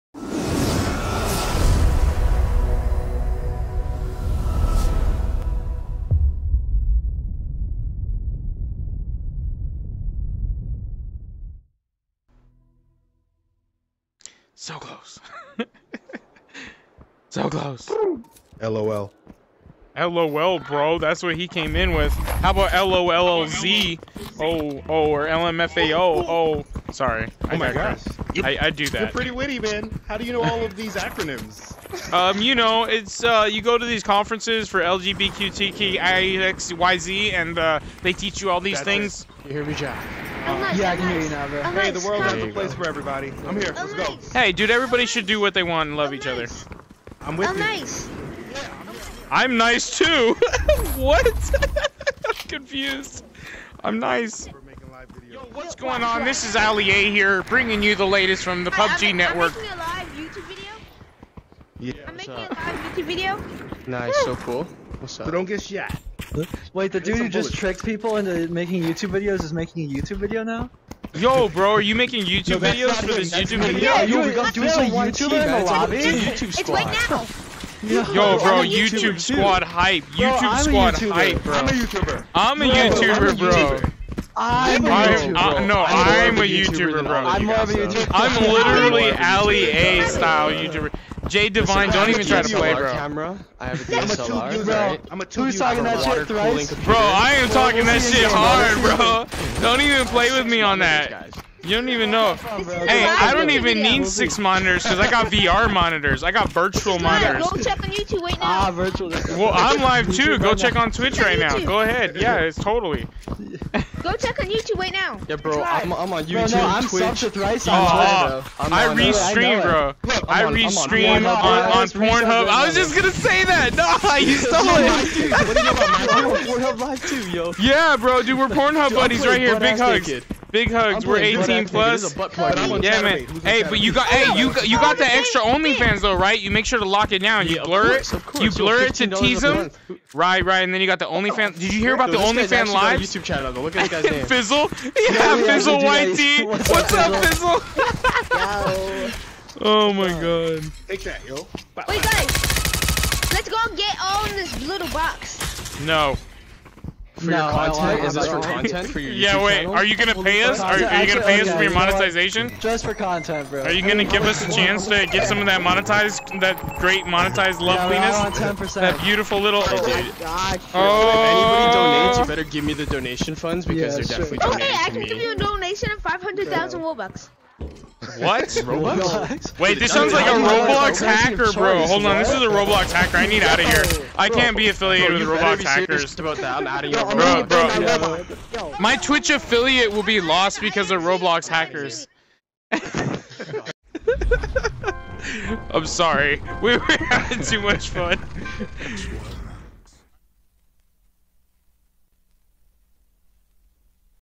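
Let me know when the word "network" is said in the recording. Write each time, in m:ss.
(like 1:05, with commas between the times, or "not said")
0:59.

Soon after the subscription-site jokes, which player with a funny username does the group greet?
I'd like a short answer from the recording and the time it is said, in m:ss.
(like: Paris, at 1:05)
Fizzle Whitey, at 2:25.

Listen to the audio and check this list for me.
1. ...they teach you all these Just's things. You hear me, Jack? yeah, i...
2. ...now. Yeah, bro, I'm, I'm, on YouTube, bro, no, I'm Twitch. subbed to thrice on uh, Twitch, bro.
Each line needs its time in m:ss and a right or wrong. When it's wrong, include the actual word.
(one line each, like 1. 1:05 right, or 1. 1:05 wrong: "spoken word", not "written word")
1. 0:38 wrong: "That", not "Just"
2. 1:54 right.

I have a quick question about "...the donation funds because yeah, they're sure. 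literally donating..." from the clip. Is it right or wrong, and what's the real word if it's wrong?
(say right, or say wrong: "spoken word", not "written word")
wrong: "definitely", not "literally".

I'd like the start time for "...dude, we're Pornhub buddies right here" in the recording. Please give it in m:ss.
2:08.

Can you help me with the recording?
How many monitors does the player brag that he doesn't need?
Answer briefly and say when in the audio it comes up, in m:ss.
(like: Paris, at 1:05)
6, at 1:44.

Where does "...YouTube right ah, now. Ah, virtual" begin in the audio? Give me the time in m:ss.
1:47.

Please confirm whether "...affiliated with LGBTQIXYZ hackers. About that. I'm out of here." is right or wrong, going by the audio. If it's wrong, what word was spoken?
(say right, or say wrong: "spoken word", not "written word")
wrong: "Roblox", not "LGBTQIXYZ".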